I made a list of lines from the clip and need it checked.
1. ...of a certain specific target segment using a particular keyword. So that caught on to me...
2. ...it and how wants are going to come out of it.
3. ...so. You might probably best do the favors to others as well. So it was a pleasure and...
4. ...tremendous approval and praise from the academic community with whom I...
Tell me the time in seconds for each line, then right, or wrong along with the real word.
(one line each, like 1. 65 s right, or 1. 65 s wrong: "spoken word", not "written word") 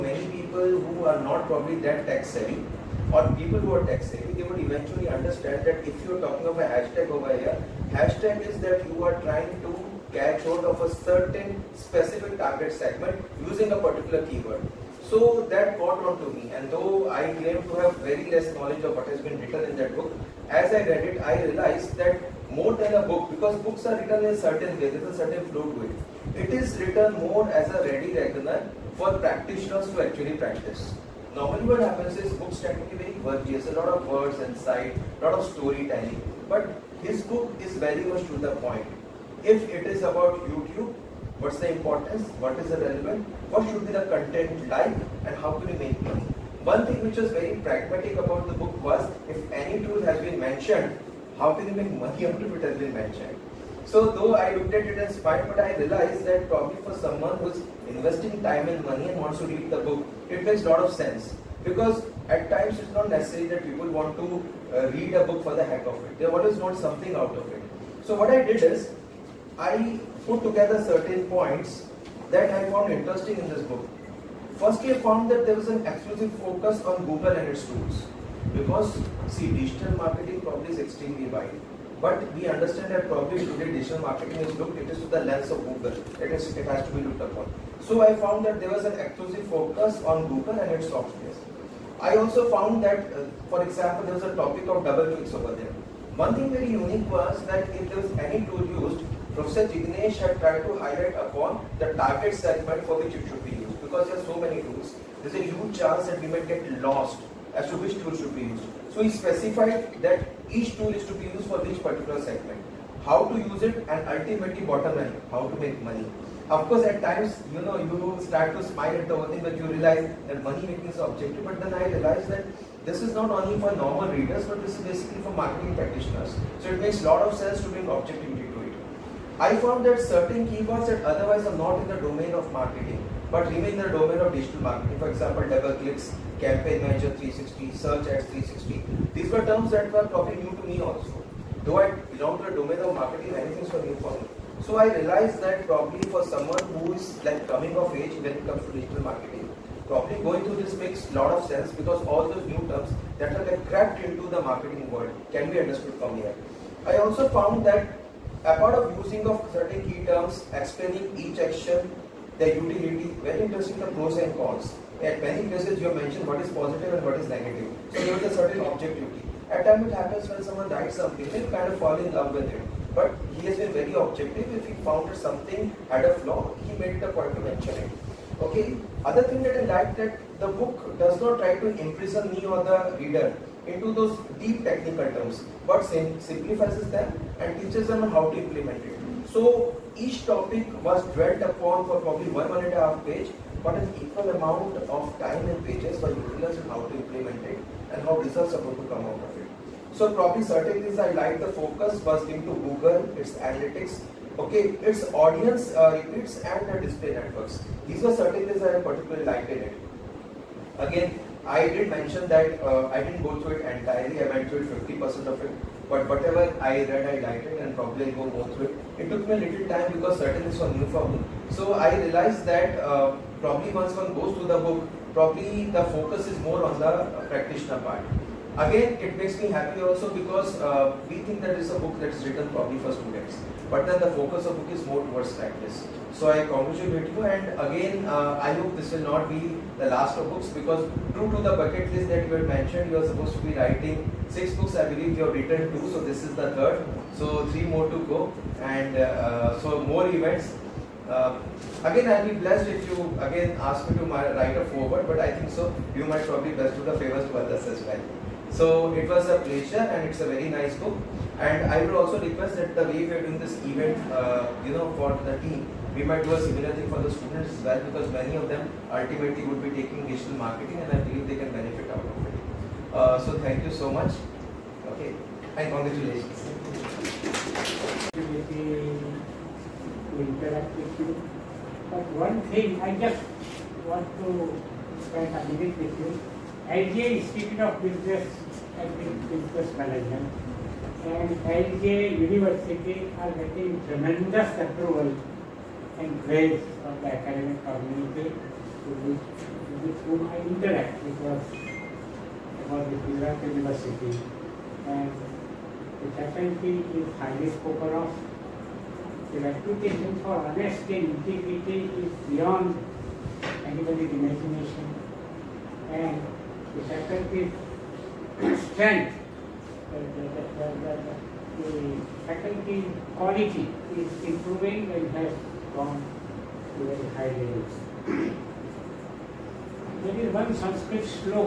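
1. 10 s right
2. 197 s wrong: "results", not "wants"
3. 255 s right
4. 293 s right.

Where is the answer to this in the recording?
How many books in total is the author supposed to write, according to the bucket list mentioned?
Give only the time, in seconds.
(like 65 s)
244 s.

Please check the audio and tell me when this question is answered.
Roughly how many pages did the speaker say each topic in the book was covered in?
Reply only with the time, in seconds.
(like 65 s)
192 s.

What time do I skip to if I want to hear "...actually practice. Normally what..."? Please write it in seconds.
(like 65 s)
30 s.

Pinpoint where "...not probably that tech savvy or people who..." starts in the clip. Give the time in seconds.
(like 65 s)
1 s.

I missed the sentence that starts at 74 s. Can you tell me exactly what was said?
Firstly, I found that there was an exclusive focus on Google and its tools.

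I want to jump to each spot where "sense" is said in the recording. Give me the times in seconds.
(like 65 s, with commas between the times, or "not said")
60 s, 127 s, 151 s.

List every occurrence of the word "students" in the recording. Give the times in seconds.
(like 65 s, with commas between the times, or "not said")
232 s, 267 s.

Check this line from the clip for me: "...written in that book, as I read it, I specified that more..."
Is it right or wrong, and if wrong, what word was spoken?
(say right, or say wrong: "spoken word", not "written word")
wrong: "realized", not "specified".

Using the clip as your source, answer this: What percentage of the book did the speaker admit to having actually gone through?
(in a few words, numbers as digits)
50%.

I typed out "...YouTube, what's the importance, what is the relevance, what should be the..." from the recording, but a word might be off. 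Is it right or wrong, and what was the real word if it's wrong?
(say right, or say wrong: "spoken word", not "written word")
right.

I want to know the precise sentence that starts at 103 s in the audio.
Because there are so many tools, there's a huge chance that we might get lost as to which tool should be used.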